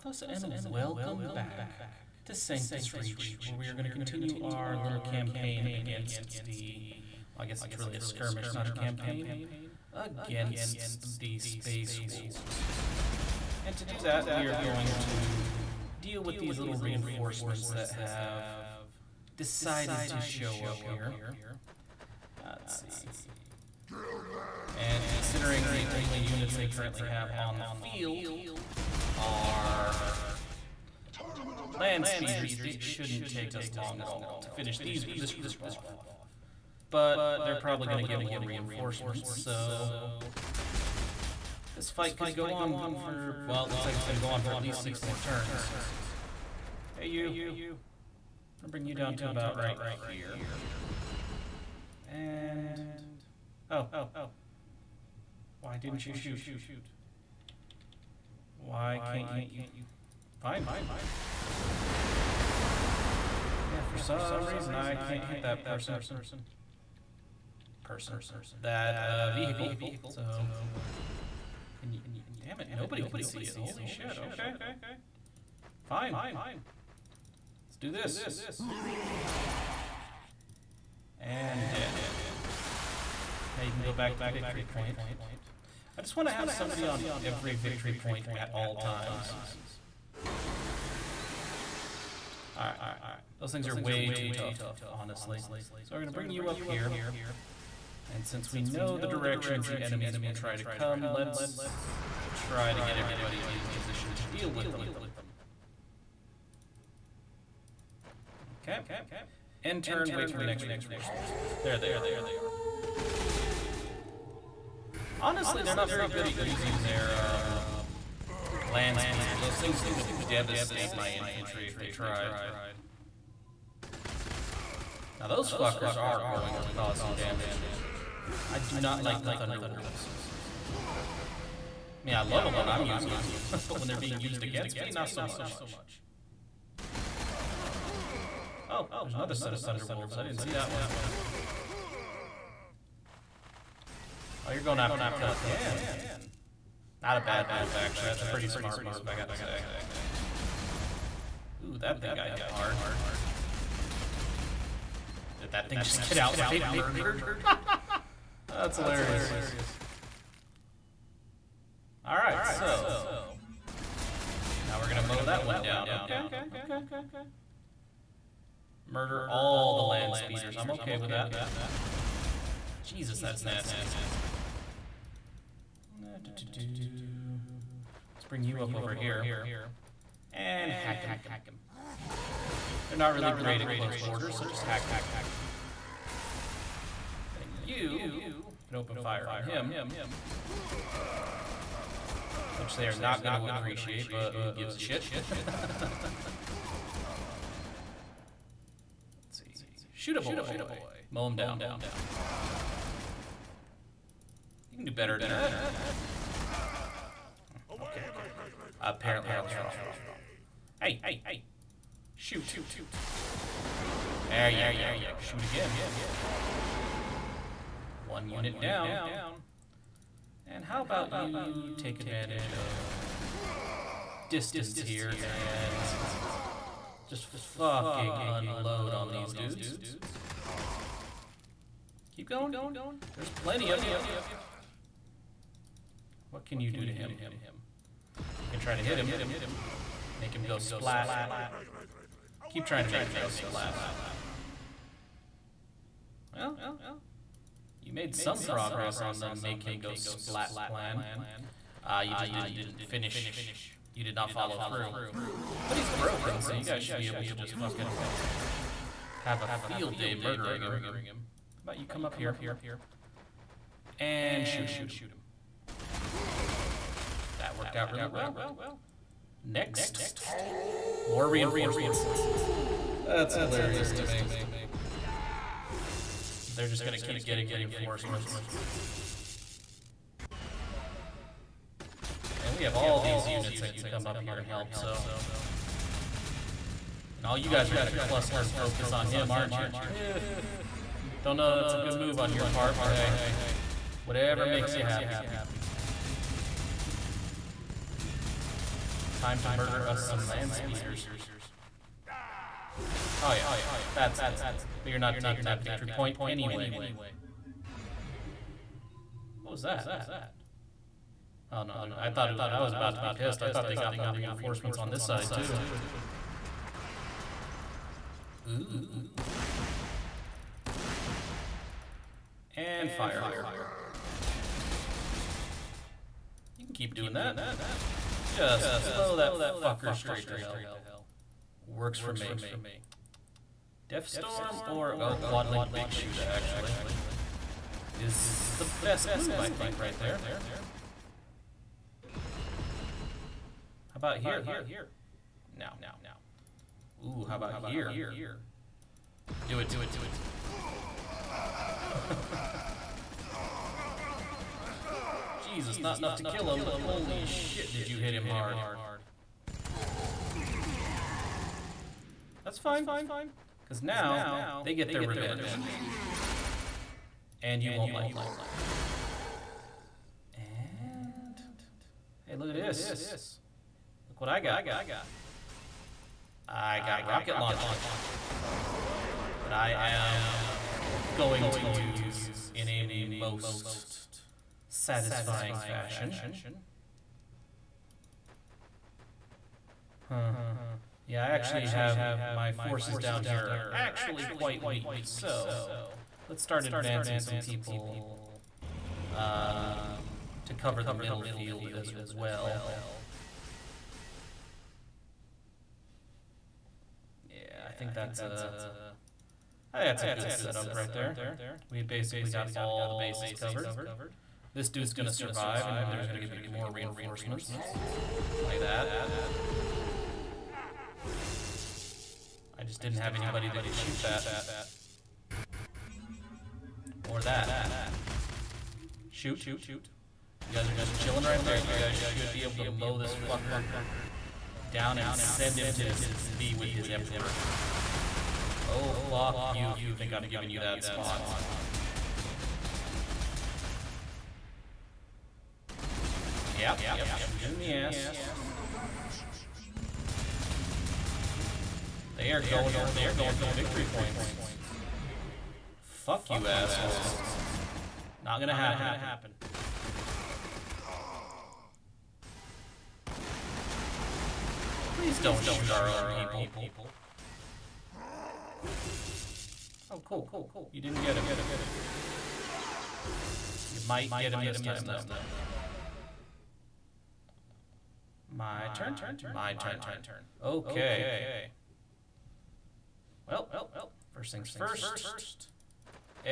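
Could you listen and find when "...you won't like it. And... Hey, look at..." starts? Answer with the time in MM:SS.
06:07.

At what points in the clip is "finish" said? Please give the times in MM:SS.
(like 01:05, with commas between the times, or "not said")
00:34, 04:12.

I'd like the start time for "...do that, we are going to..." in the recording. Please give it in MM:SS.
00:13.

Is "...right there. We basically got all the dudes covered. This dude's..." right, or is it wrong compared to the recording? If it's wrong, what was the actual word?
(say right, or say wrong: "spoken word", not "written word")
wrong: "bases", not "dudes".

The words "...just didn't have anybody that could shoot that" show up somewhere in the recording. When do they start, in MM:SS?
07:02.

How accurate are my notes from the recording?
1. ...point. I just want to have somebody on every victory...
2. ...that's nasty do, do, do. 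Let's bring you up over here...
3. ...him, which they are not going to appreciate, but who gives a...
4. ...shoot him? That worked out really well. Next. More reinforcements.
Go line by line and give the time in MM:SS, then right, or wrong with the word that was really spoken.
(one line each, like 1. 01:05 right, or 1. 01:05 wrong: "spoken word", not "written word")
1. 01:24 right
2. 02:53 right
3. 03:09 right
4. 04:24 right.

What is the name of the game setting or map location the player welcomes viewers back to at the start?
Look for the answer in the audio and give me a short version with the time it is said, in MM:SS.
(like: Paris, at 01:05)
Sanctus Reach, at 00:02.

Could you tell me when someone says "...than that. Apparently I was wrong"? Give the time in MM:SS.
03:25.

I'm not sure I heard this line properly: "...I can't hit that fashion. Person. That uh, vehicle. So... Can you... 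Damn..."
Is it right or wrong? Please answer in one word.
wrong.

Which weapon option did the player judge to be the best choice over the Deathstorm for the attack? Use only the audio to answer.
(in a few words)
Quad linked Big Shoota.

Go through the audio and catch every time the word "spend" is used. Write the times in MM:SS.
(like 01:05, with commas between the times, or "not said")
not said.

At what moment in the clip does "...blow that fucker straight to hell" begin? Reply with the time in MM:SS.
05:28.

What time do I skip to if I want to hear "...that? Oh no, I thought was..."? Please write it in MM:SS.
05:09.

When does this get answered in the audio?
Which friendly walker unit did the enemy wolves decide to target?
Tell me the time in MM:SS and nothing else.
02:25.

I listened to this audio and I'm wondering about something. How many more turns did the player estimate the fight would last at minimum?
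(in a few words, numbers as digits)
6.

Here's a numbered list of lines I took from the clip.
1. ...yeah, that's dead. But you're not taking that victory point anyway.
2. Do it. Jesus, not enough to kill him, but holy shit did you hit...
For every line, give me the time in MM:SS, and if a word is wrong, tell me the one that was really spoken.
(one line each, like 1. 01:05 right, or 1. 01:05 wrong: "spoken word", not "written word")
1. 05:03 right
2. 05:49 right.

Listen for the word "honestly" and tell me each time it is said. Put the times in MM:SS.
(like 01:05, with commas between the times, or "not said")
01:34, 01:55.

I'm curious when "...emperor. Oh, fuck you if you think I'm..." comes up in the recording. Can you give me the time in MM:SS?
07:16.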